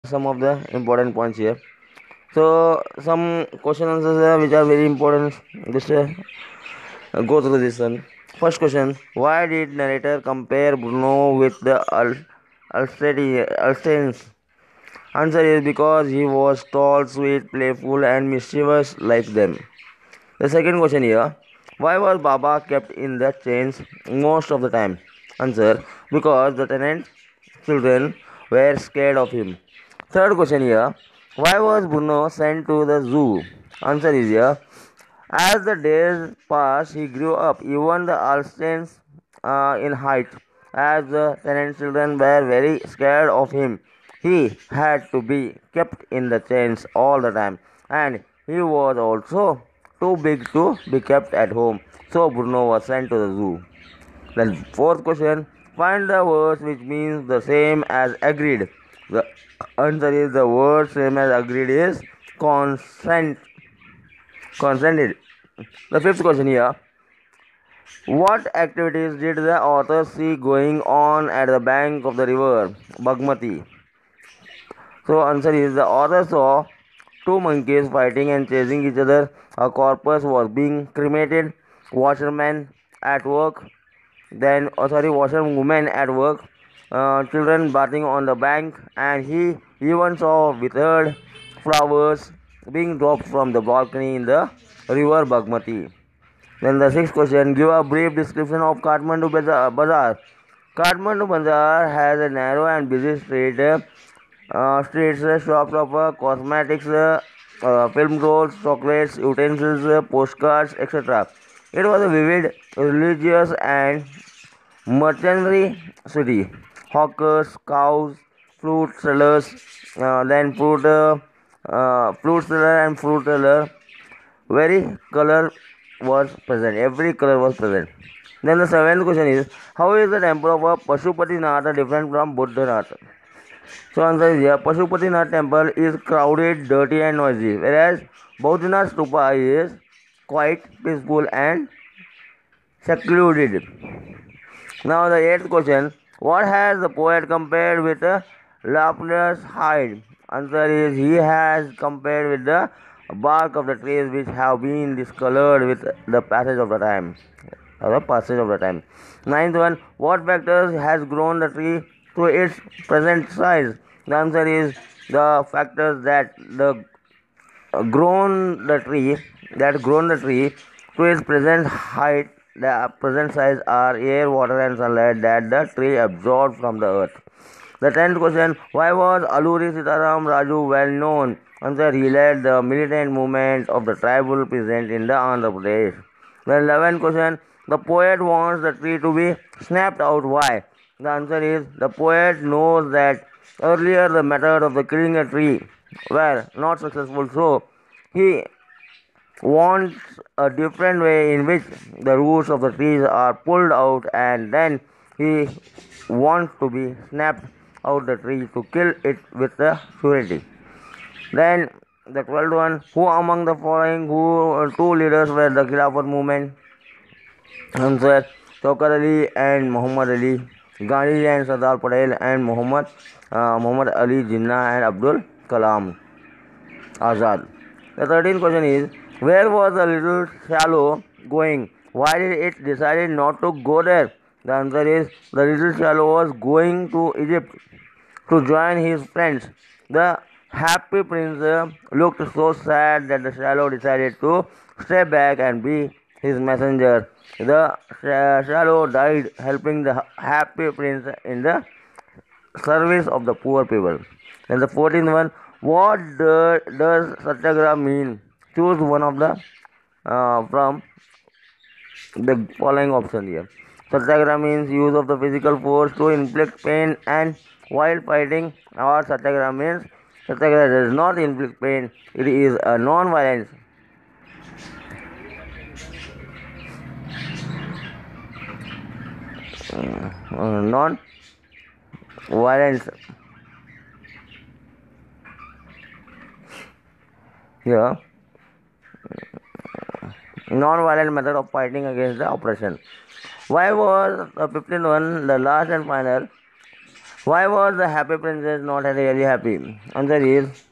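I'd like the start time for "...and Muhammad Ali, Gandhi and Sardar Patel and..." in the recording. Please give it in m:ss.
3:39.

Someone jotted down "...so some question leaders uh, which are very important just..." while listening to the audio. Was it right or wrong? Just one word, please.
wrong.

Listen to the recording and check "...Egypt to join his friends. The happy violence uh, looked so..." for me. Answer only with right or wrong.
wrong.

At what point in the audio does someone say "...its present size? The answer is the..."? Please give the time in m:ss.
2:42.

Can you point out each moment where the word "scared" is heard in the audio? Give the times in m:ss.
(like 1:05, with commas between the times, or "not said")
0:28, 0:42.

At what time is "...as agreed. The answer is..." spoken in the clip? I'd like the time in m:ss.
0:58.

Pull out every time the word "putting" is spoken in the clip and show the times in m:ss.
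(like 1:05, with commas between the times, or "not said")
not said.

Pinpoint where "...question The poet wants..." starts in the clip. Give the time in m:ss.
3:07.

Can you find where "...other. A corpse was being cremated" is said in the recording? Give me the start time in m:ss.
1:18.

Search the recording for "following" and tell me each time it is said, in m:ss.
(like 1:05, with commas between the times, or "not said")
3:33, 4:22.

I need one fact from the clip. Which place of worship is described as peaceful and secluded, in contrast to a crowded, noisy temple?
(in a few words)
Bodhinath stupa.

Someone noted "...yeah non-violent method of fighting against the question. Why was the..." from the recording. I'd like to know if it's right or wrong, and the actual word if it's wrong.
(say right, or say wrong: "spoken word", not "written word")
wrong: "oppression", not "question".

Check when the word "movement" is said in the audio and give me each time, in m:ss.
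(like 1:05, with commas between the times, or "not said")
3:03, 3:36.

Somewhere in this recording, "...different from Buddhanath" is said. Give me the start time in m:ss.
2:11.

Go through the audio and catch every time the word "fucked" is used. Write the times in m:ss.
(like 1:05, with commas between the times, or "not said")
not said.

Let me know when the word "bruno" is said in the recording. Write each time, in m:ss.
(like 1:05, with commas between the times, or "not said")
0:10, 0:31, 0:52.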